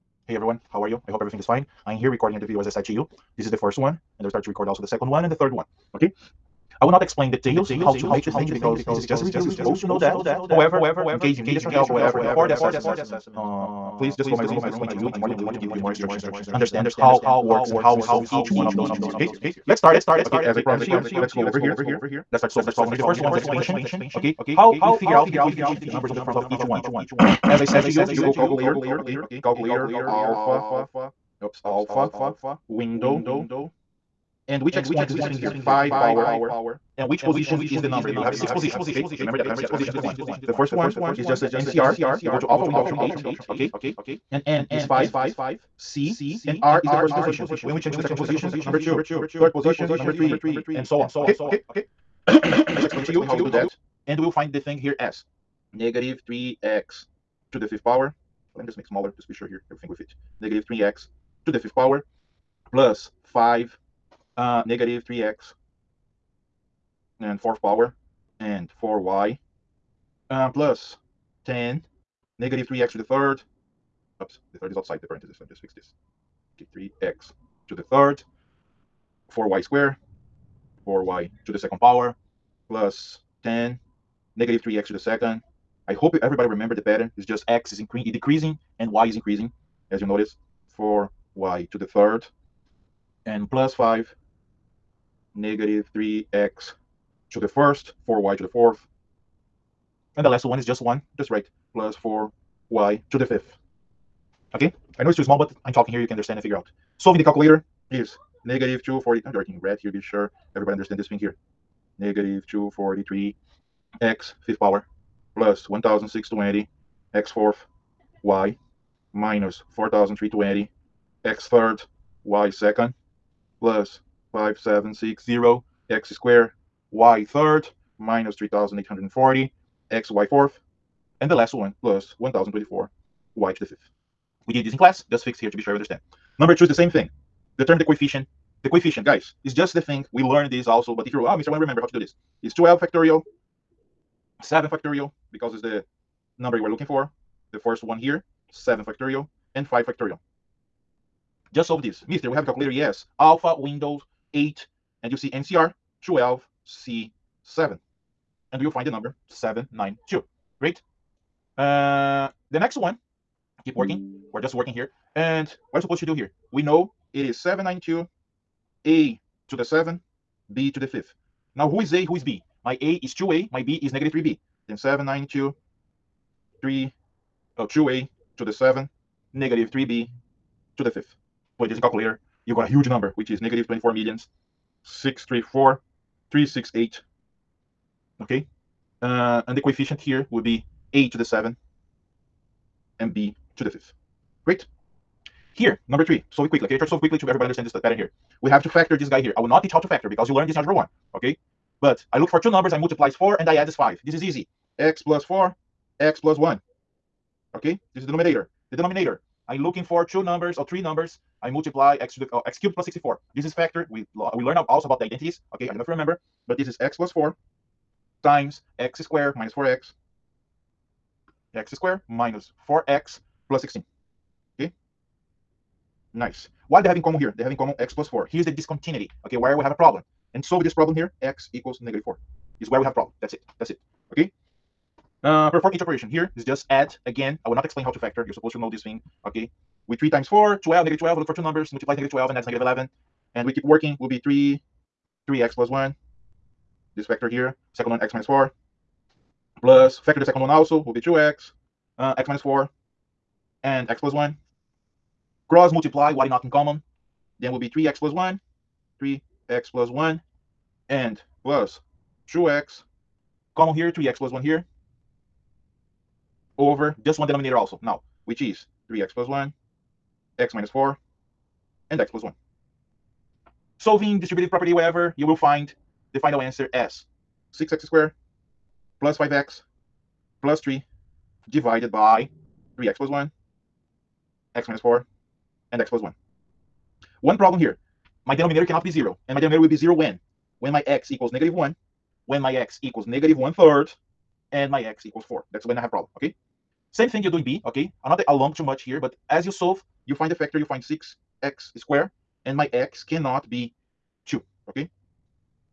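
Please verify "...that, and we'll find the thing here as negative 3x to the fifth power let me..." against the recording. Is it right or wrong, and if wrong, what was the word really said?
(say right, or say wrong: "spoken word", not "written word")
right.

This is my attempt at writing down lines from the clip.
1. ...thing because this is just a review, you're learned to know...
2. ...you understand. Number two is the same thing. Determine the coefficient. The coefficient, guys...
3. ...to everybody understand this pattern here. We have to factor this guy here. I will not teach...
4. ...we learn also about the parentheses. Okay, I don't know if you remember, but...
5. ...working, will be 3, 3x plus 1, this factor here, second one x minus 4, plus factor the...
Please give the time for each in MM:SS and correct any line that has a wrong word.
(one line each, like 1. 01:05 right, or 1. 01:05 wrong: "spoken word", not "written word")
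1. 00:08 wrong: "supposed", not "learned"
2. 02:15 right
3. 03:17 right
4. 03:34 wrong: "identities", not "parentheses"
5. 04:03 right.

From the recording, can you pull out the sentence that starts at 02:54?
Then 792 3 oh, 2a to the 7 negative 3b to the fifth.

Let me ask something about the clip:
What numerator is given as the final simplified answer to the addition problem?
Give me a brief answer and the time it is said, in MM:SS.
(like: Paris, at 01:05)
6x^2 + 5x + 3, at 04:37.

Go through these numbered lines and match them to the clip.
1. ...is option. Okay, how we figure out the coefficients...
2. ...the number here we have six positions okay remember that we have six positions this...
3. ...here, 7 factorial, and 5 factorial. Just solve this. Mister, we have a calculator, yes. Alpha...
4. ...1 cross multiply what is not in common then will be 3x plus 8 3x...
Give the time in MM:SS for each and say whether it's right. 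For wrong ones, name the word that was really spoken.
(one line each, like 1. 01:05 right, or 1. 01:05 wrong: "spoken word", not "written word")
1. 00:23 wrong: "expansion", not "option"
2. 00:37 right
3. 02:27 right
4. 04:14 wrong: "1", not "8".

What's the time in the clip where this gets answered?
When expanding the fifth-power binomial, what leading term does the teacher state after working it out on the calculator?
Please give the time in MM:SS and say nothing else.
01:51.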